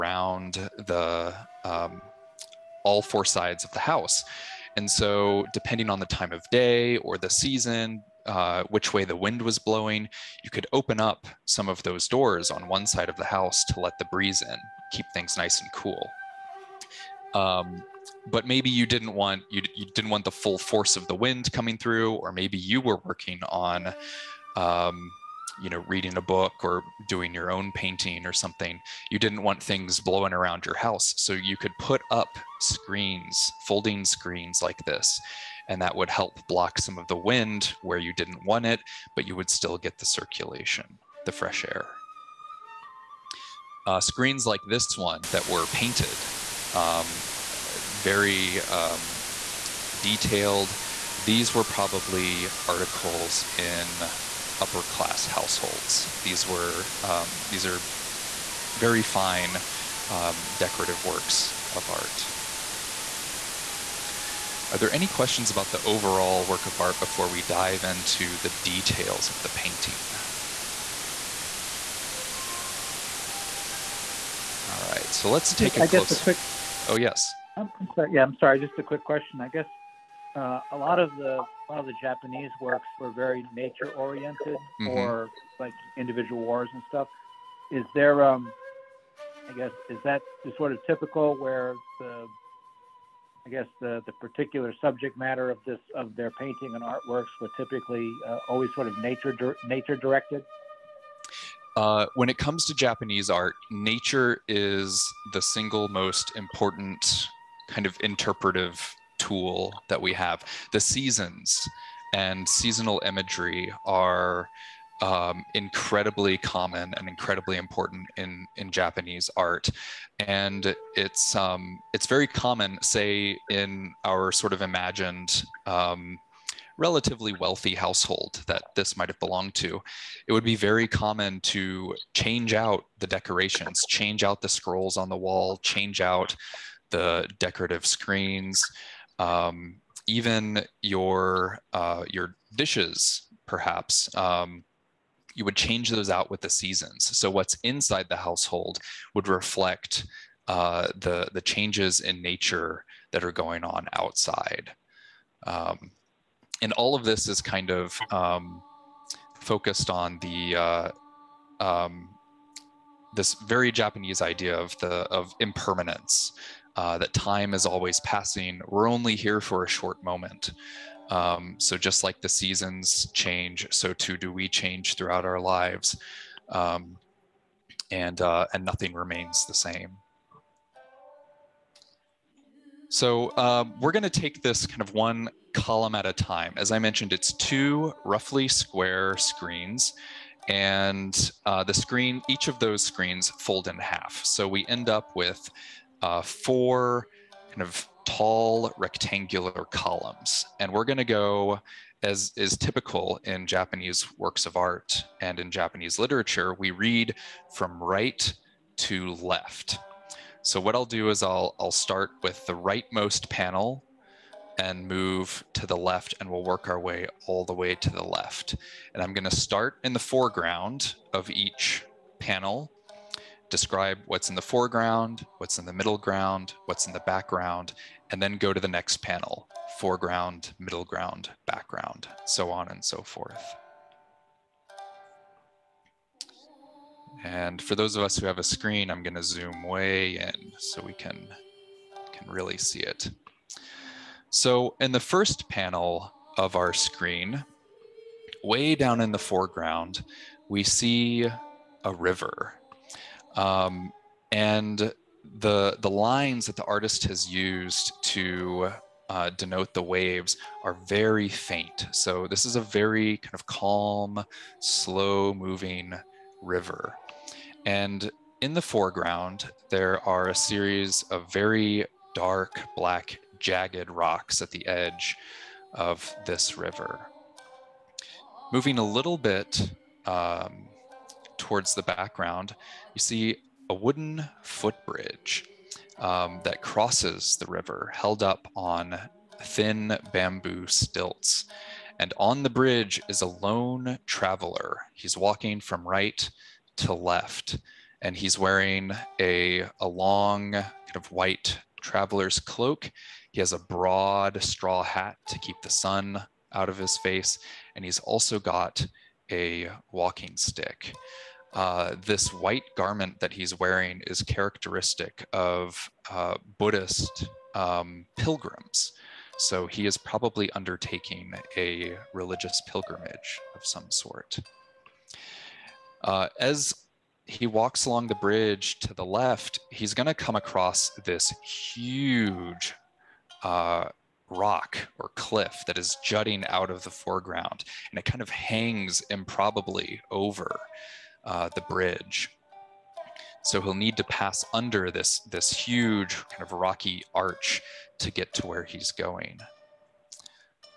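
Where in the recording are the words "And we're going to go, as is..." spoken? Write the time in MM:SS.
03:20.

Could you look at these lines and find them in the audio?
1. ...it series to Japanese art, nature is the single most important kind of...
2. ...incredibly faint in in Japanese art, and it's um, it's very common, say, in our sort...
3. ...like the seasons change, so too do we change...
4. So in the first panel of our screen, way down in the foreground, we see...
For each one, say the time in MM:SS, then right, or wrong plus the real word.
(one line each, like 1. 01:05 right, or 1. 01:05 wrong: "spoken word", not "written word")
1. 01:42 wrong: "comes", not "series"
2. 01:57 wrong: "important", not "faint"
3. 02:52 right
4. 04:04 right.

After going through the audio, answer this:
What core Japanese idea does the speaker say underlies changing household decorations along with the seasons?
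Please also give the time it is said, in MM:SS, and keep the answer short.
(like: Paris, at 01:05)
Impermanence, at 02:45.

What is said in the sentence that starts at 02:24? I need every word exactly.
Um, you would change those out with the seasons.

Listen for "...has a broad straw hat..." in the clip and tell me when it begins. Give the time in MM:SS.
05:03.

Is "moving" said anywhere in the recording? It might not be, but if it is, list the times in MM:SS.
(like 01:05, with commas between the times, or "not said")
04:25, 04:38.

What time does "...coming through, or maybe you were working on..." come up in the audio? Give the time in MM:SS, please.
00:21.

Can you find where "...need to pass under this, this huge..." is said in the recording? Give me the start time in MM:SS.
05:43.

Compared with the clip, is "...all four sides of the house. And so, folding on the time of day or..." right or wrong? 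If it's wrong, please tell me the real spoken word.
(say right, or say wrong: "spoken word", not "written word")
wrong: "depending", not "folding".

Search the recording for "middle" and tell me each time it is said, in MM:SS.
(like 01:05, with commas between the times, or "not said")
03:45, 03:50.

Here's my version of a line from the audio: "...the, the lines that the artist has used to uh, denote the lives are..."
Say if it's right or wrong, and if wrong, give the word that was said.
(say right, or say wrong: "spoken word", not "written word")
wrong: "waves", not "lives".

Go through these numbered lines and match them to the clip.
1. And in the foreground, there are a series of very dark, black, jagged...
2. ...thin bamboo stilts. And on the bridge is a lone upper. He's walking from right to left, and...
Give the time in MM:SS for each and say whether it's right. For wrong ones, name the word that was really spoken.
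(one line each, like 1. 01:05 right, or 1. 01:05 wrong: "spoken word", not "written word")
1. 04:27 right
2. 04:49 wrong: "traveler", not "upper".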